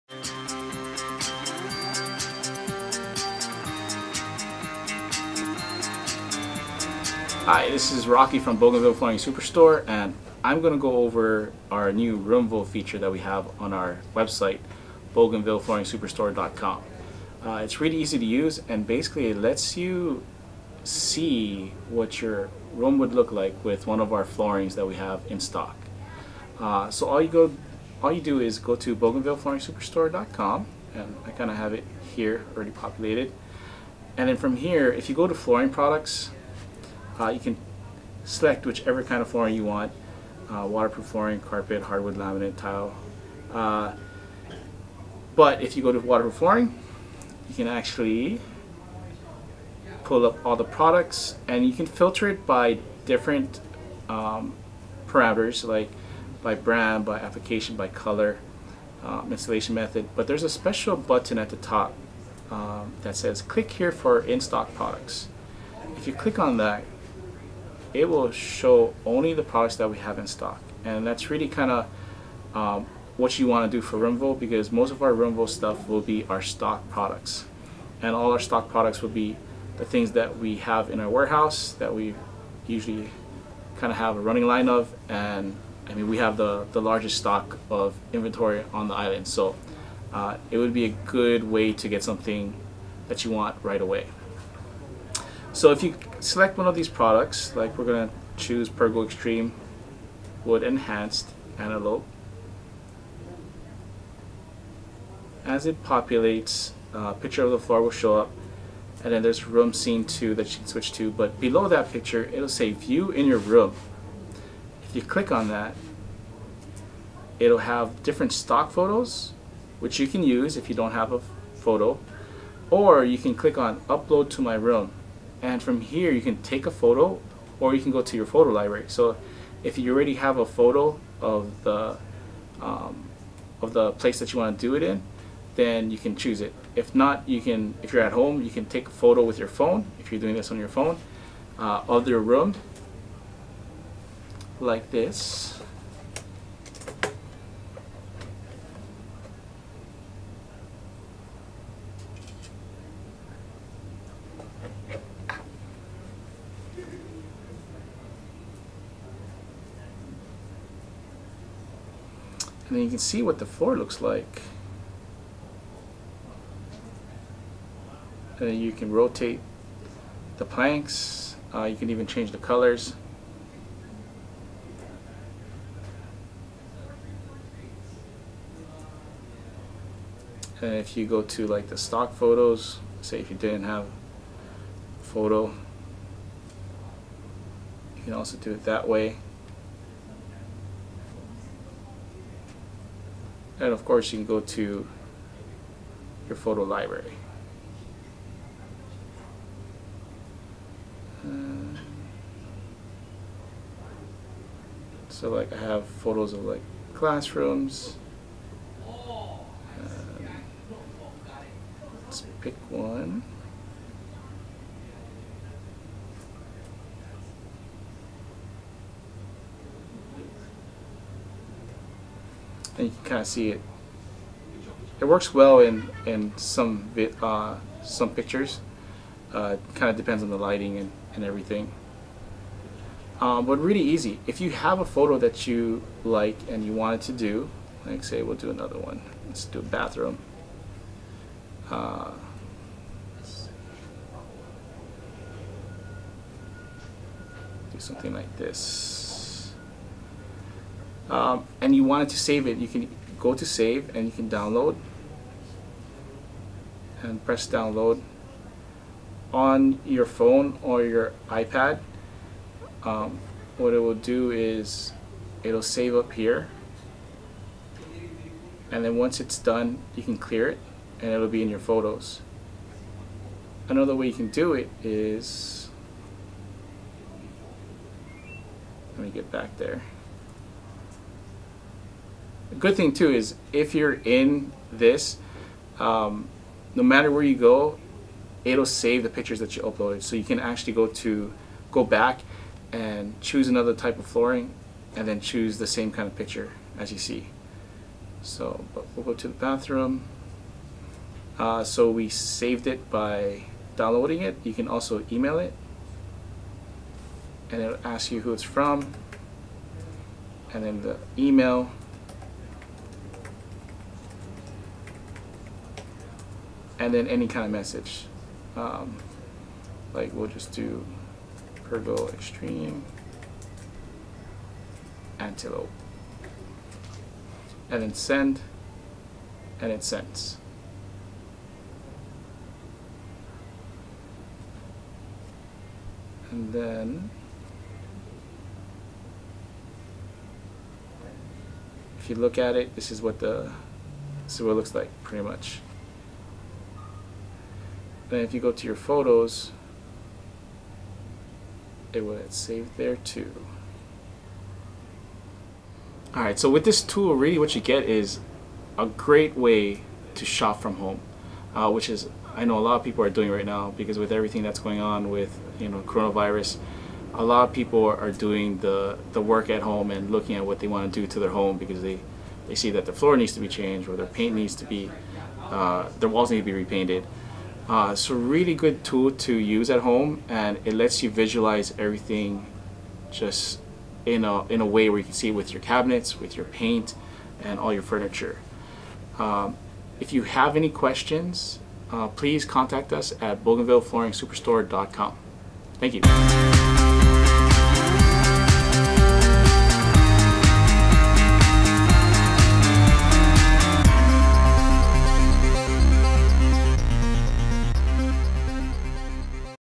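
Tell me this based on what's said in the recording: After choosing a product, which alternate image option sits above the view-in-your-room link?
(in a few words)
room scene 2.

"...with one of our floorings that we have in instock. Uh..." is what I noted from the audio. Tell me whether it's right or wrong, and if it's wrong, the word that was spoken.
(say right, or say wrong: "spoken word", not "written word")
wrong: "stock", not "instock".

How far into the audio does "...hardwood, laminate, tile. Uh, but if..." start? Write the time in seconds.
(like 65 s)
41 s.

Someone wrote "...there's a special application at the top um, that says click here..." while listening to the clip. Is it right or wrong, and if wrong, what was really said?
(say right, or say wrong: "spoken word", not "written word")
wrong: "button", not "application".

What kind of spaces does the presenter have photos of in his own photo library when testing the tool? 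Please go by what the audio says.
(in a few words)
classrooms.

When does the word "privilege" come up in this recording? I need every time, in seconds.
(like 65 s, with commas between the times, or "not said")
not said.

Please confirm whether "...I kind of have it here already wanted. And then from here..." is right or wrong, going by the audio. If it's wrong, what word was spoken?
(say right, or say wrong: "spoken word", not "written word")
wrong: "populated", not "wanted".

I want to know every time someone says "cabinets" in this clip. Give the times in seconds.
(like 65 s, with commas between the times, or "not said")
385 s.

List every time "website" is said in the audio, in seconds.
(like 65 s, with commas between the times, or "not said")
14 s.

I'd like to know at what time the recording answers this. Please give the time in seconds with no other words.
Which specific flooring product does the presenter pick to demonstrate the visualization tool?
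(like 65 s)
98 s.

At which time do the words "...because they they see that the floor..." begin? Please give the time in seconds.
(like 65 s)
371 s.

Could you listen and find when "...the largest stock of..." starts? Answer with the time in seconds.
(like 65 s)
86 s.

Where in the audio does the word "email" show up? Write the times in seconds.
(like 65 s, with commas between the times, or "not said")
305 s, 311 s.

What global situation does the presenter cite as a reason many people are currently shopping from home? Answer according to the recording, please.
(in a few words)
coronavirus.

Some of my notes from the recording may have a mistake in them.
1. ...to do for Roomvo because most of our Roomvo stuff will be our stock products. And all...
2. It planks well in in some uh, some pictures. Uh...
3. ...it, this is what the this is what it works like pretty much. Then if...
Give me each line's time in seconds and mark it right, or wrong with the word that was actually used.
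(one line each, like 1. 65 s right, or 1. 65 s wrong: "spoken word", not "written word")
1. 73 s right
2. 224 s wrong: "works", not "planks"
3. 342 s wrong: "looks", not "works".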